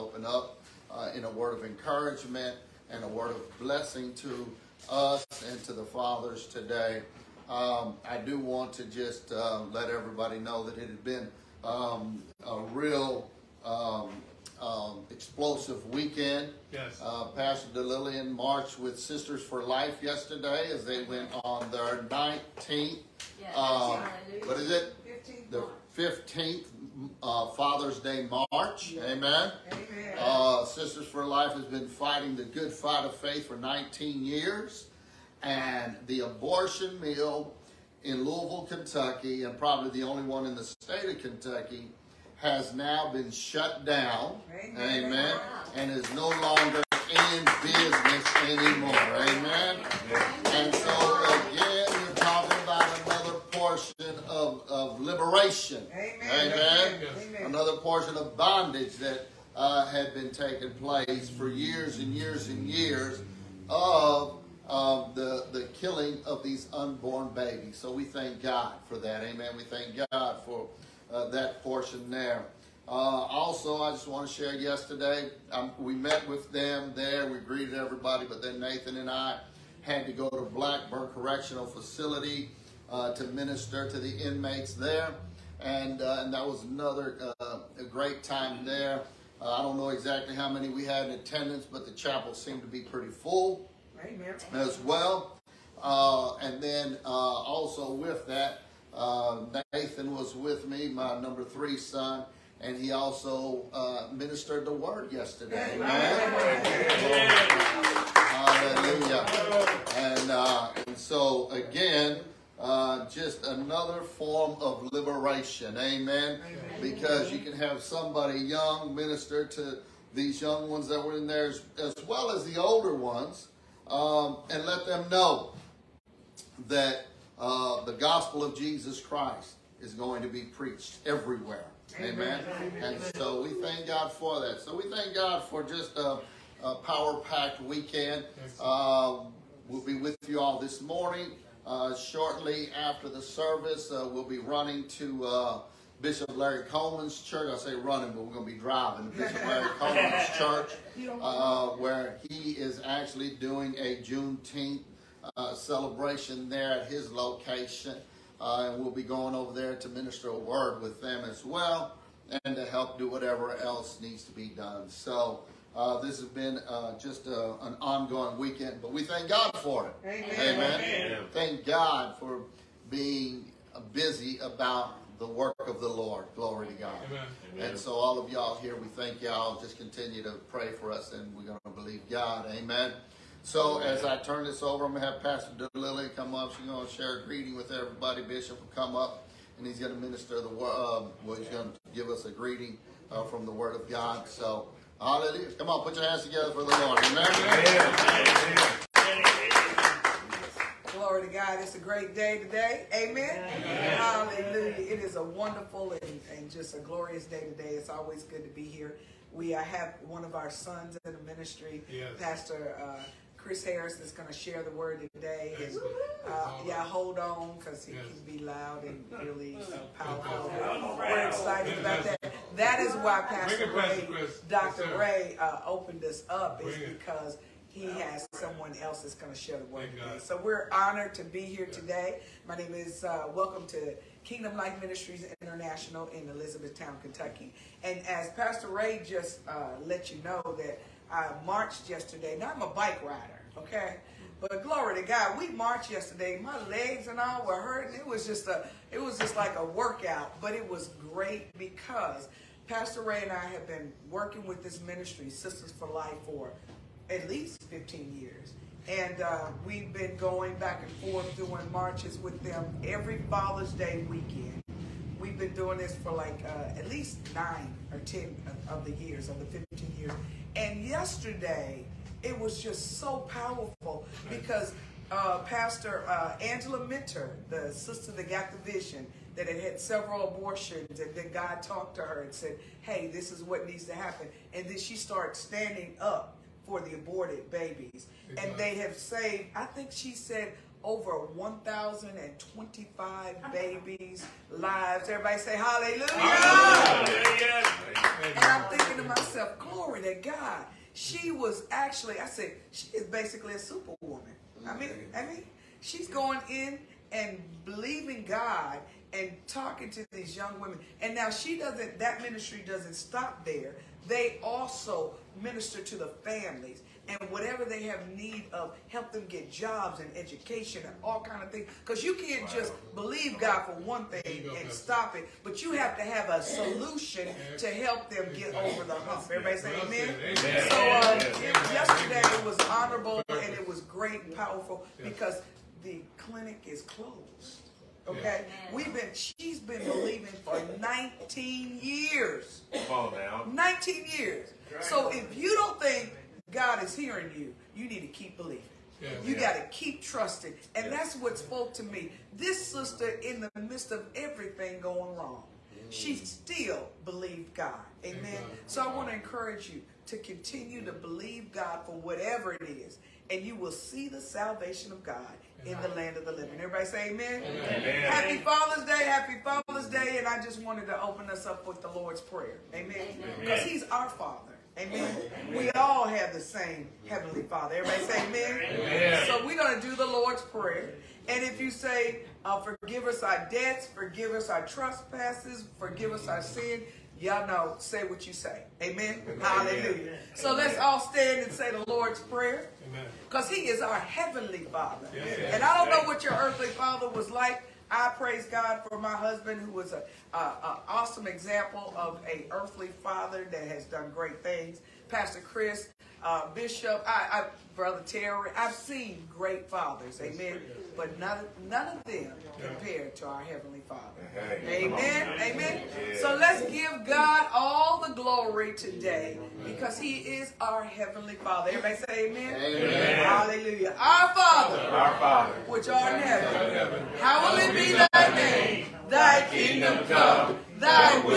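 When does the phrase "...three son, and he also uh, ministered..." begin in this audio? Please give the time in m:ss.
1:41.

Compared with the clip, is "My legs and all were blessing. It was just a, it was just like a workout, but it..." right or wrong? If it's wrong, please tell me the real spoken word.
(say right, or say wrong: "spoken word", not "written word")
wrong: "hurting", not "blessing".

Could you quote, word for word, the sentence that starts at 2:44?
So uh, this has been uh, just a, uh, an ongoing weekend, but we thank God for it.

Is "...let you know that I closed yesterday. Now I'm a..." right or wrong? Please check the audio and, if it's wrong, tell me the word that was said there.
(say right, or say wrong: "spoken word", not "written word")
wrong: "marched", not "closed".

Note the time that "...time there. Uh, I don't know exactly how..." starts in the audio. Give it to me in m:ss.
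1:28.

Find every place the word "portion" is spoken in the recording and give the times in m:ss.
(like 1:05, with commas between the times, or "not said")
0:53, 0:57, 1:11.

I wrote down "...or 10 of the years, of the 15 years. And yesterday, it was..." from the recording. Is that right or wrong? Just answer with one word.
right.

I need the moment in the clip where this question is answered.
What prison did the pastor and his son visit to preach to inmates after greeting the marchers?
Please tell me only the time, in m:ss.
1:20.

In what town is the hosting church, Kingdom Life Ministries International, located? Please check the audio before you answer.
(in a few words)
Elizabethtown, Kentucky.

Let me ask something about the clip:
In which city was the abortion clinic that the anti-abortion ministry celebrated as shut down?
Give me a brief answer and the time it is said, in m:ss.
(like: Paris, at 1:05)
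Louisville, Kentucky, at 0:38.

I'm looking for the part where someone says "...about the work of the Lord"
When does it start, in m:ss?
2:54.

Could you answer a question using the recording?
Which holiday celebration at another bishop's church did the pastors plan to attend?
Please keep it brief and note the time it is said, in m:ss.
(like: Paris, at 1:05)
Juneteenth, at 2:34.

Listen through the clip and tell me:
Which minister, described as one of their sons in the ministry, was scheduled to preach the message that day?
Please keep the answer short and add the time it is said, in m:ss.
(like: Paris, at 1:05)
Chris Harris, at 3:33.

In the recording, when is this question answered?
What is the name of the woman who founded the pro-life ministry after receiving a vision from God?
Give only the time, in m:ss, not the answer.
4:36.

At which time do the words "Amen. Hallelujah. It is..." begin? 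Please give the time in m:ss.
3:23.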